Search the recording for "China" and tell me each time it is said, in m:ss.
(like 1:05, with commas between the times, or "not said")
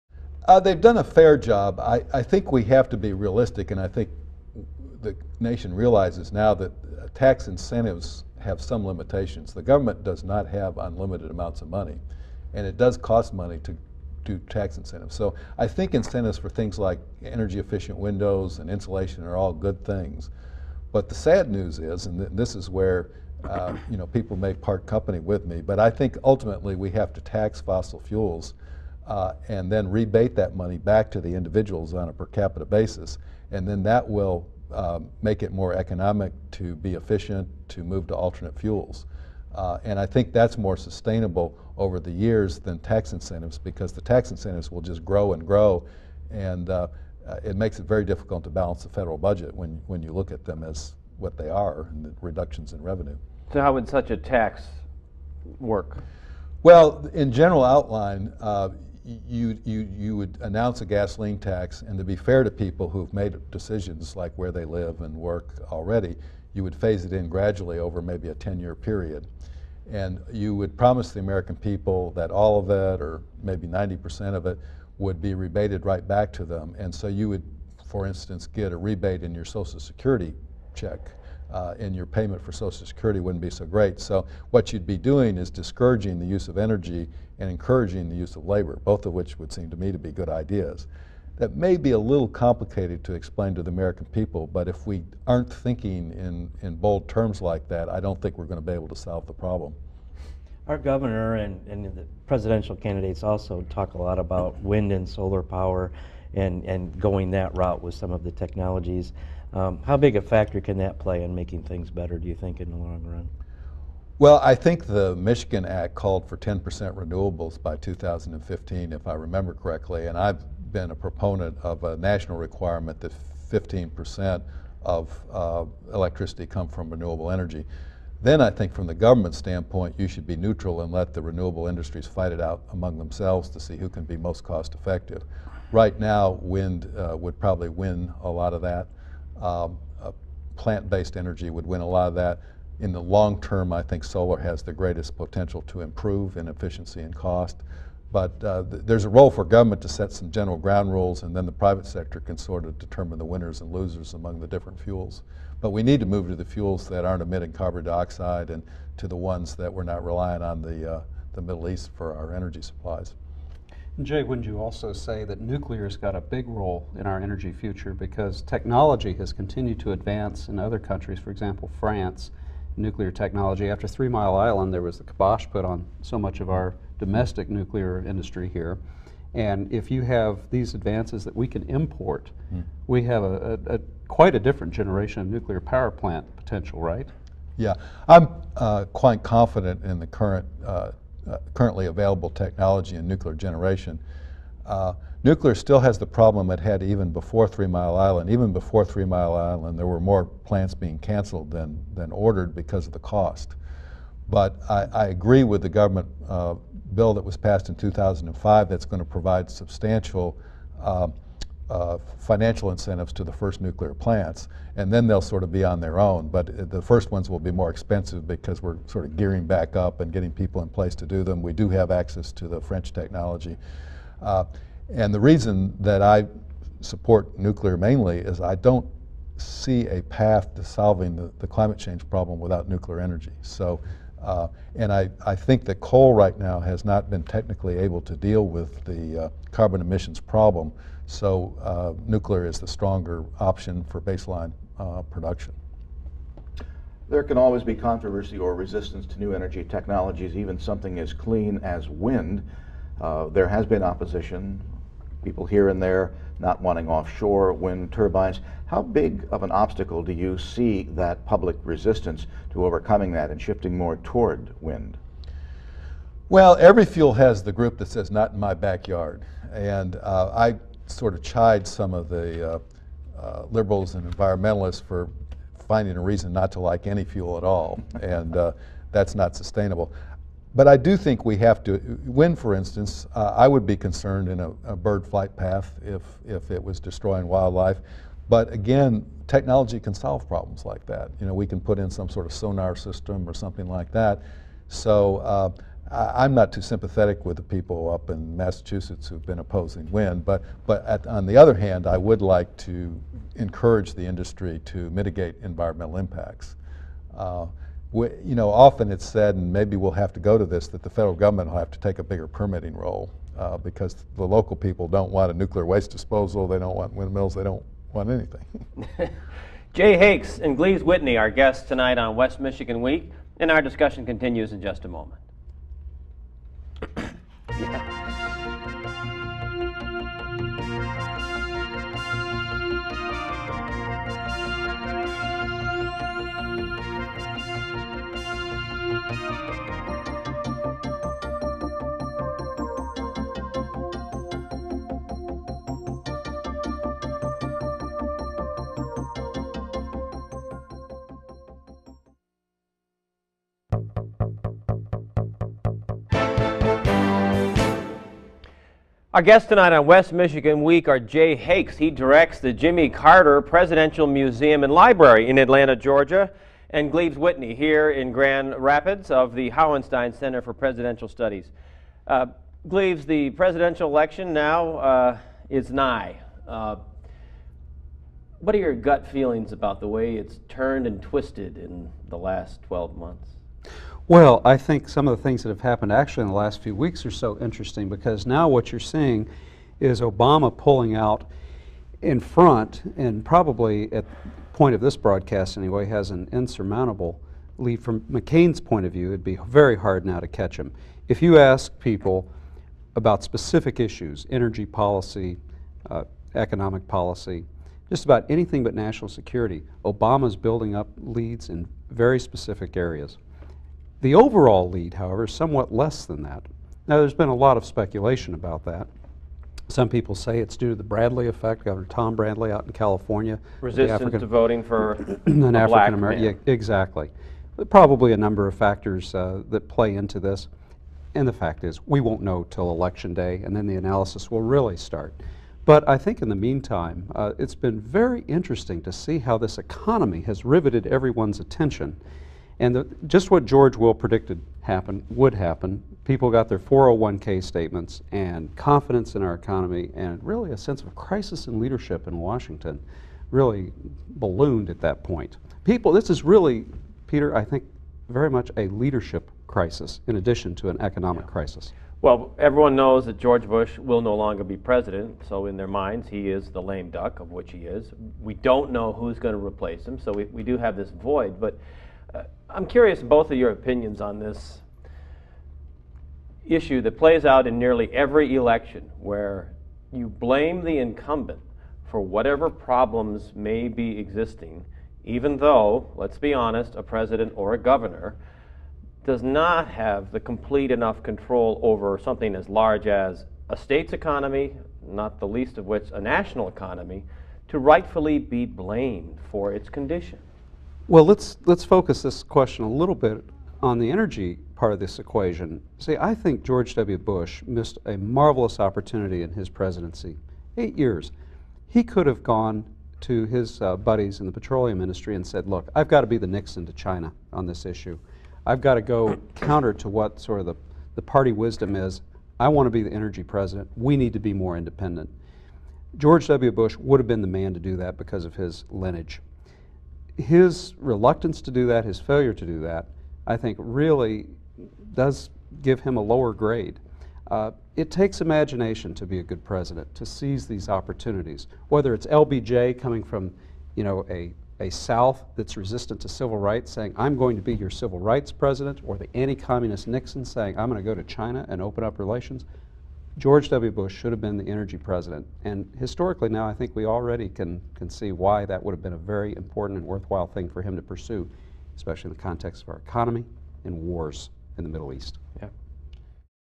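8:36, 9:11.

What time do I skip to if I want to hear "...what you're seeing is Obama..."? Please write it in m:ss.
6:28.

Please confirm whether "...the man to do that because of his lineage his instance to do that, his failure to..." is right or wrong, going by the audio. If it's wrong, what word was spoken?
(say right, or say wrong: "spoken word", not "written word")
wrong: "reluctance", not "instance".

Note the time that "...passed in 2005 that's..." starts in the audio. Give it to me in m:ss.
3:27.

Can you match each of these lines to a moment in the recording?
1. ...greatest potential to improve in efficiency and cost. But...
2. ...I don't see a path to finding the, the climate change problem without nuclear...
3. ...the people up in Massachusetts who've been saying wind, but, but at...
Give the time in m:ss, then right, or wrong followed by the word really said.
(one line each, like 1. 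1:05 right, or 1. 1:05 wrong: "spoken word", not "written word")
1. 2:24 right
2. 3:48 wrong: "solving", not "finding"
3. 4:57 wrong: "opposing", not "saying".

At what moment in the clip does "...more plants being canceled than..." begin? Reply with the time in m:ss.
3:19.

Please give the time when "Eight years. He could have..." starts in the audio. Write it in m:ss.
8:30.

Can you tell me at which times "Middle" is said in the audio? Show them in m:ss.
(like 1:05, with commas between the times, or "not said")
2:41, 9:24.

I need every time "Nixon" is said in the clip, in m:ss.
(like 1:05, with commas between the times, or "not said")
8:36, 9:09.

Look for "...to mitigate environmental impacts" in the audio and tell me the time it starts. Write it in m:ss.
5:04.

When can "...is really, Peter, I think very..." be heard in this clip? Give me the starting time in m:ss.
7:36.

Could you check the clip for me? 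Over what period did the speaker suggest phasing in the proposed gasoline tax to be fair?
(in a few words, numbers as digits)
10-year period.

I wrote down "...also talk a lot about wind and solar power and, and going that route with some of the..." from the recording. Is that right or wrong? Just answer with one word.
right.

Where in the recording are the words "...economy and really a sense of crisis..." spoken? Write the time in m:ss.
7:29.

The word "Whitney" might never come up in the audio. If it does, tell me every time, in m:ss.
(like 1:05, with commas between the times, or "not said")
5:20, 6:07.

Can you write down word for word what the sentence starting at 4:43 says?
Uh, I would be concerned in a, a bird flight path if if it was destroying wildlife.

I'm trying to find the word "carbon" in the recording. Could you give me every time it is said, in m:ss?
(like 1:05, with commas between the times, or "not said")
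2:37, 3:59.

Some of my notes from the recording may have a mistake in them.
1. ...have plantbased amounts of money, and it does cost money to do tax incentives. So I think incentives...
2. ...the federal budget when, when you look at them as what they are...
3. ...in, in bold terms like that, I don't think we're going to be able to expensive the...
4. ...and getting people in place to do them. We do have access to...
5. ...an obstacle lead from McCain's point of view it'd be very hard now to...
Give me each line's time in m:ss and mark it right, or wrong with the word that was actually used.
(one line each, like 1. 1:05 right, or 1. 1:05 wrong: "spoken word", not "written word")
1. 0:10 wrong: "unlimited", not "plantbased"
2. 0:48 right
3. 1:36 wrong: "solve", not "expensive"
4. 3:40 right
5. 6:36 wrong: "insurmountable", not "obstacle".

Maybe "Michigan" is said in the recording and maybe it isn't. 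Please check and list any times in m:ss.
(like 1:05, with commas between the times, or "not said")
1:55, 5:22, 6:00.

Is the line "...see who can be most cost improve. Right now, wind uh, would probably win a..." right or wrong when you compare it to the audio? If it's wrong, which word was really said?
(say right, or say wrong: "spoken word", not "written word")
wrong: "effective", not "improve".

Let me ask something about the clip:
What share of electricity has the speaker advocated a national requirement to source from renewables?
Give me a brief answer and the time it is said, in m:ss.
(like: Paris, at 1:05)
15%, at 2:03.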